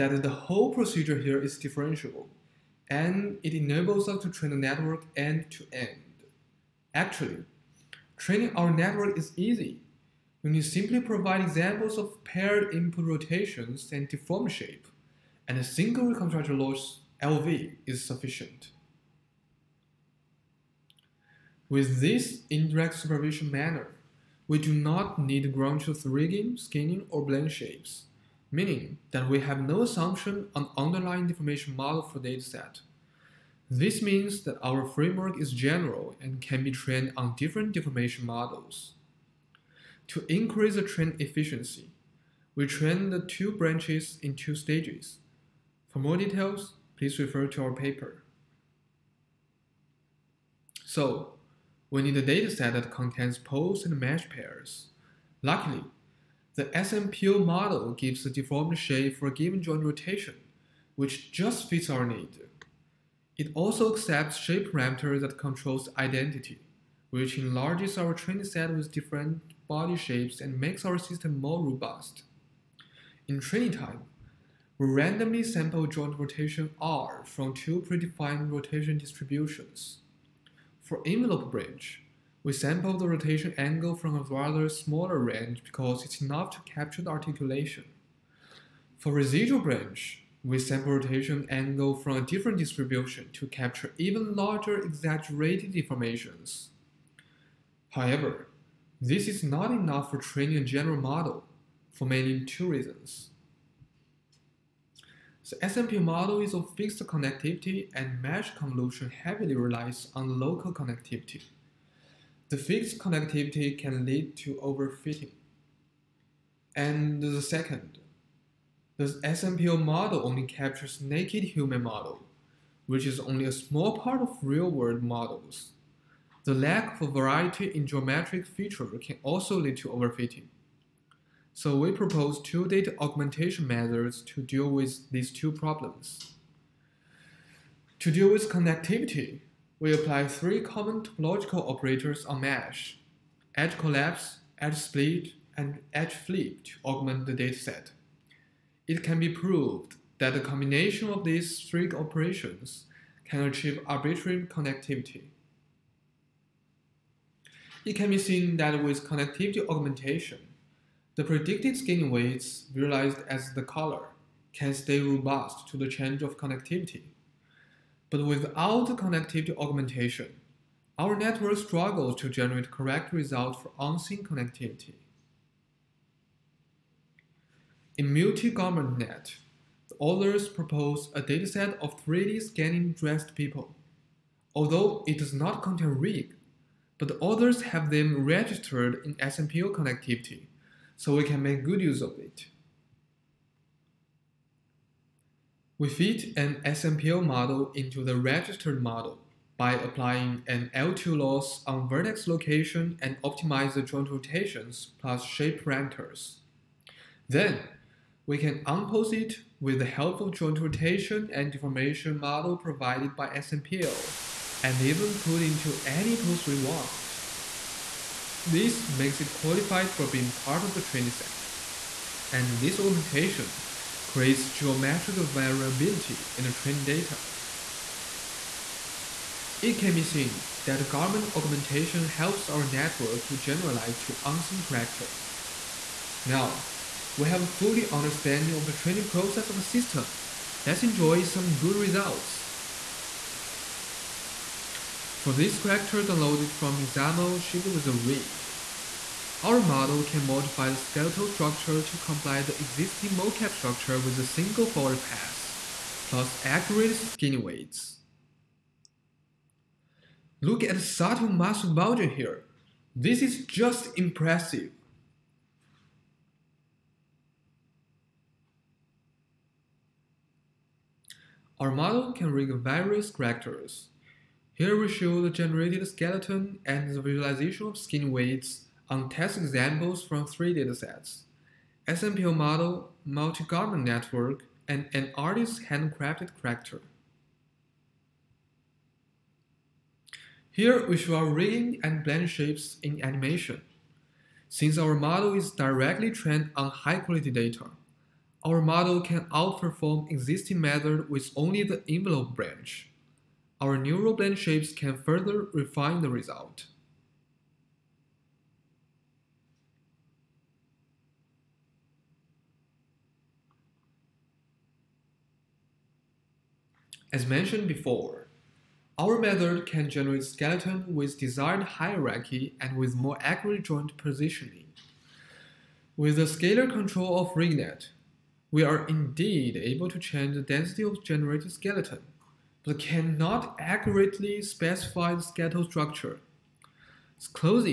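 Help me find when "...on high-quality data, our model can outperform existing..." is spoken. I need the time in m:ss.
4:56.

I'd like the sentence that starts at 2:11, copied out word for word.
So we propose two data augmentation methods to deal with these two problems.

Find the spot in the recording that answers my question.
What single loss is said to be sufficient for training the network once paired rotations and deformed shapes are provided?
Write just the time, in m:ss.
0:16.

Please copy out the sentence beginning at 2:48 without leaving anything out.
But without connectivity augmentation, our network struggles to generate correct results for unseen connectivity.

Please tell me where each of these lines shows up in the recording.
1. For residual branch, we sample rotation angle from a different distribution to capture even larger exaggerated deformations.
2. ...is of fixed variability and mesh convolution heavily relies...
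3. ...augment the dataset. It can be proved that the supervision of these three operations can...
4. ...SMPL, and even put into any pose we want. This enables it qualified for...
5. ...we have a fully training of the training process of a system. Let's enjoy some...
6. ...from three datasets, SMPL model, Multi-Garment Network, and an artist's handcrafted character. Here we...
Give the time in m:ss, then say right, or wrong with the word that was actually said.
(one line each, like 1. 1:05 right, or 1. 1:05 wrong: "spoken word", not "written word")
1. 1:28 right
2. 1:46 wrong: "connectivity", not "variability"
3. 2:26 wrong: "combination", not "supervision"
4. 3:33 wrong: "makes", not "enables"
5. 3:57 wrong: "understanding", not "training"
6. 4:40 right.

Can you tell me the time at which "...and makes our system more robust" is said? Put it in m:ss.
1:10.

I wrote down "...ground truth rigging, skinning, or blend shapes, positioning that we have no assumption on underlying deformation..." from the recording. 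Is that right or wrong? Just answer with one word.
wrong.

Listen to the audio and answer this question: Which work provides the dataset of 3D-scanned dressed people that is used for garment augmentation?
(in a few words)
Multi-Garment Net.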